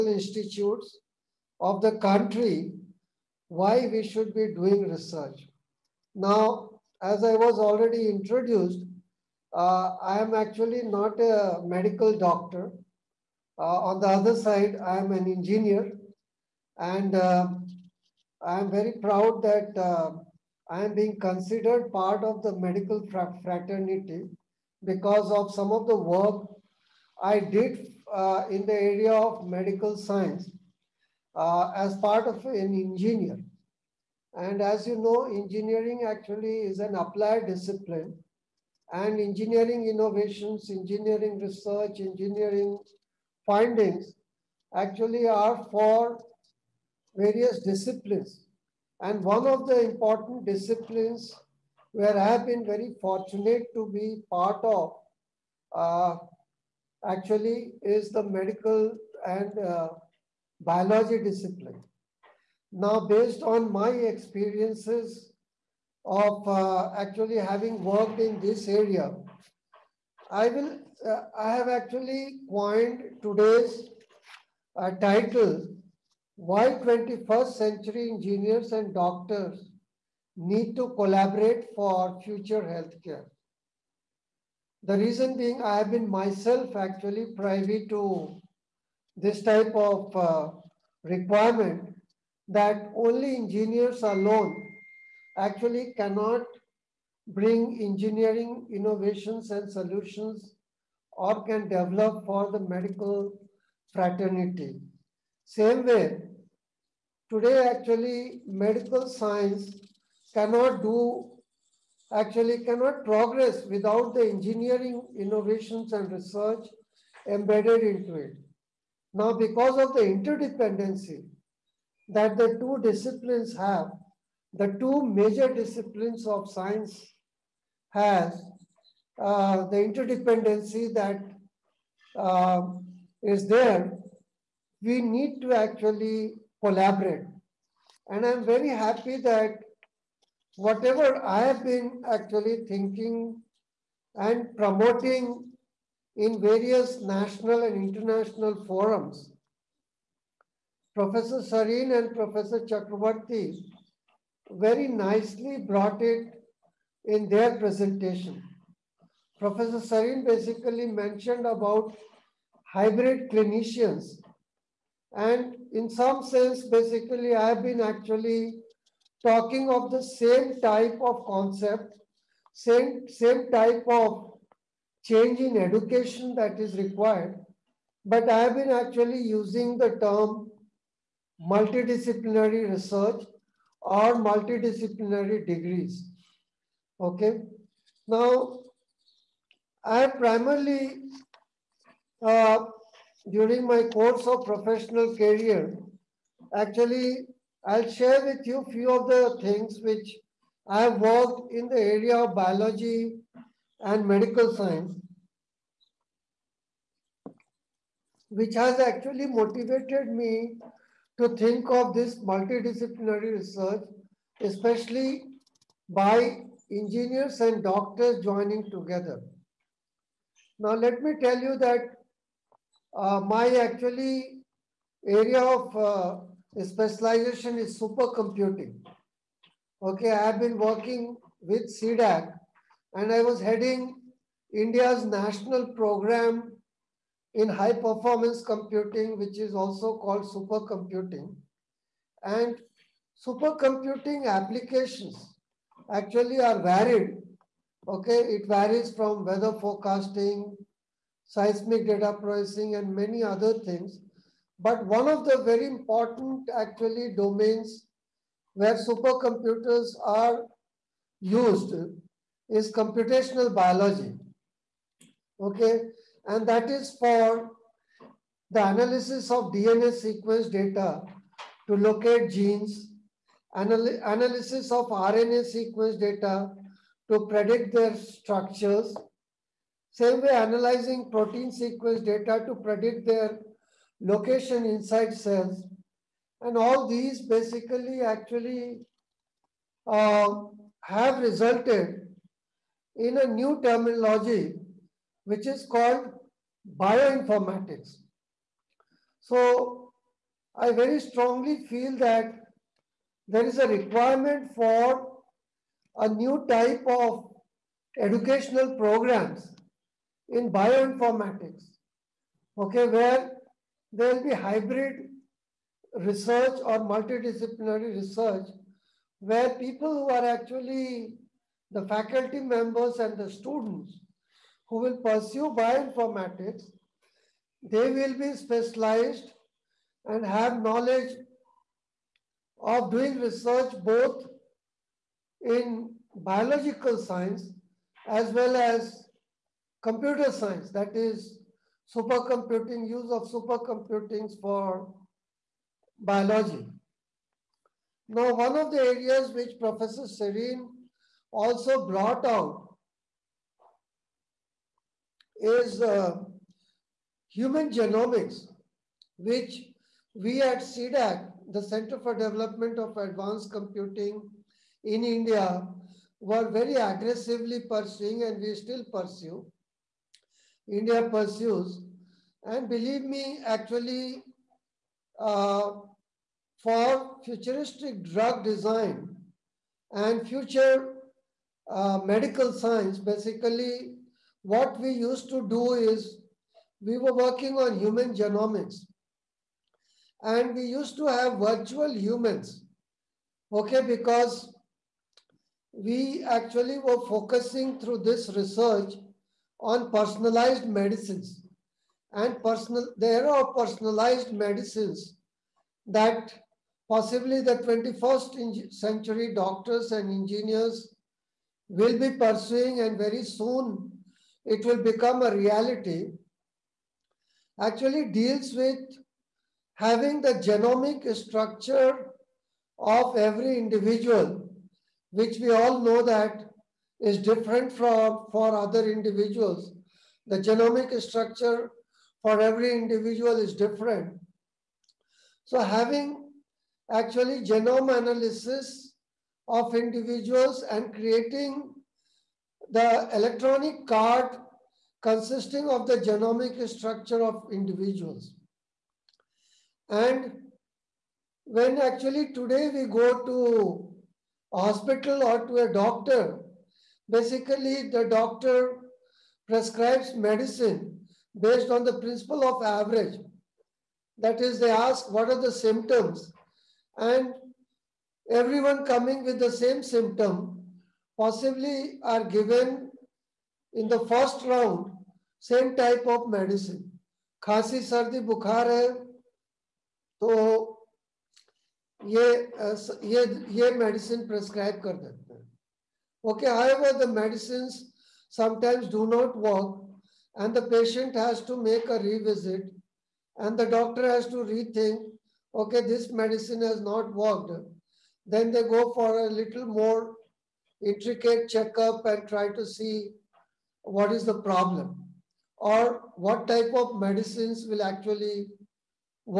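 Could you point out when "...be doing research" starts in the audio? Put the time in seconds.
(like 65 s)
4 s.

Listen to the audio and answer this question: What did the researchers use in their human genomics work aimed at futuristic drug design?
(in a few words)
virtual humans.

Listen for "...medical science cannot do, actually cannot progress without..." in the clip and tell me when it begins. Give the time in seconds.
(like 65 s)
108 s.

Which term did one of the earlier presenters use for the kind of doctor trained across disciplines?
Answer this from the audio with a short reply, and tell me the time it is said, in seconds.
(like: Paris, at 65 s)
hybrid clinicians, at 162 s.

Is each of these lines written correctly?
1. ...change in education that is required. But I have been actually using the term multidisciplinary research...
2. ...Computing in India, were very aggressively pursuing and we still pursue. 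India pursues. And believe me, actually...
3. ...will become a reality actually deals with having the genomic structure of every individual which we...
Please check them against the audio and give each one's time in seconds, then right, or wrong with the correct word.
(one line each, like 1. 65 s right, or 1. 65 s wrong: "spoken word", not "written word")
1. 175 s right
2. 363 s right
3. 414 s right.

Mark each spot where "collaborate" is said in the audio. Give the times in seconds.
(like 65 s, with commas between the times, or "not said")
80 s, 136 s.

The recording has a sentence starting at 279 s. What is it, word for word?
Same way, analyzing protein sequence data to predict their location inside cells.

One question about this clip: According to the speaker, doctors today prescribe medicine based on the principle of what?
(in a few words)
average.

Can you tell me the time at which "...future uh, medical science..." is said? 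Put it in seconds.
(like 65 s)
380 s.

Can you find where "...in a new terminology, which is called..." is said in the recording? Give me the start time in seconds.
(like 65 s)
292 s.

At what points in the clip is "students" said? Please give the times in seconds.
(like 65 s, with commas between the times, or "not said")
323 s.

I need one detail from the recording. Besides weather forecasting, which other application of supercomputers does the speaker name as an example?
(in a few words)
seismic data processing.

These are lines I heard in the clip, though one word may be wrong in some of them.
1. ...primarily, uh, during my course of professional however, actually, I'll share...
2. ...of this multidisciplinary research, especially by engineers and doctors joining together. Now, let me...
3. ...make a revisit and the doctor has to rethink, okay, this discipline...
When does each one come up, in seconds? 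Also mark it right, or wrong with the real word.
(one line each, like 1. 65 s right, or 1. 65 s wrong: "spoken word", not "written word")
1. 190 s wrong: "career", not "however"
2. 211 s right
3. 491 s wrong: "medicine", not "discipline".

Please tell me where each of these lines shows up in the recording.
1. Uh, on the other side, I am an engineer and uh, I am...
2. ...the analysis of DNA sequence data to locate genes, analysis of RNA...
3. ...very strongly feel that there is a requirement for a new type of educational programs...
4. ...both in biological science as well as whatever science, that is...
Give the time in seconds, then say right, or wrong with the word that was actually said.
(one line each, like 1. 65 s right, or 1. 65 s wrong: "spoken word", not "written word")
1. 13 s right
2. 268 s right
3. 300 s right
4. 333 s wrong: "computer", not "whatever".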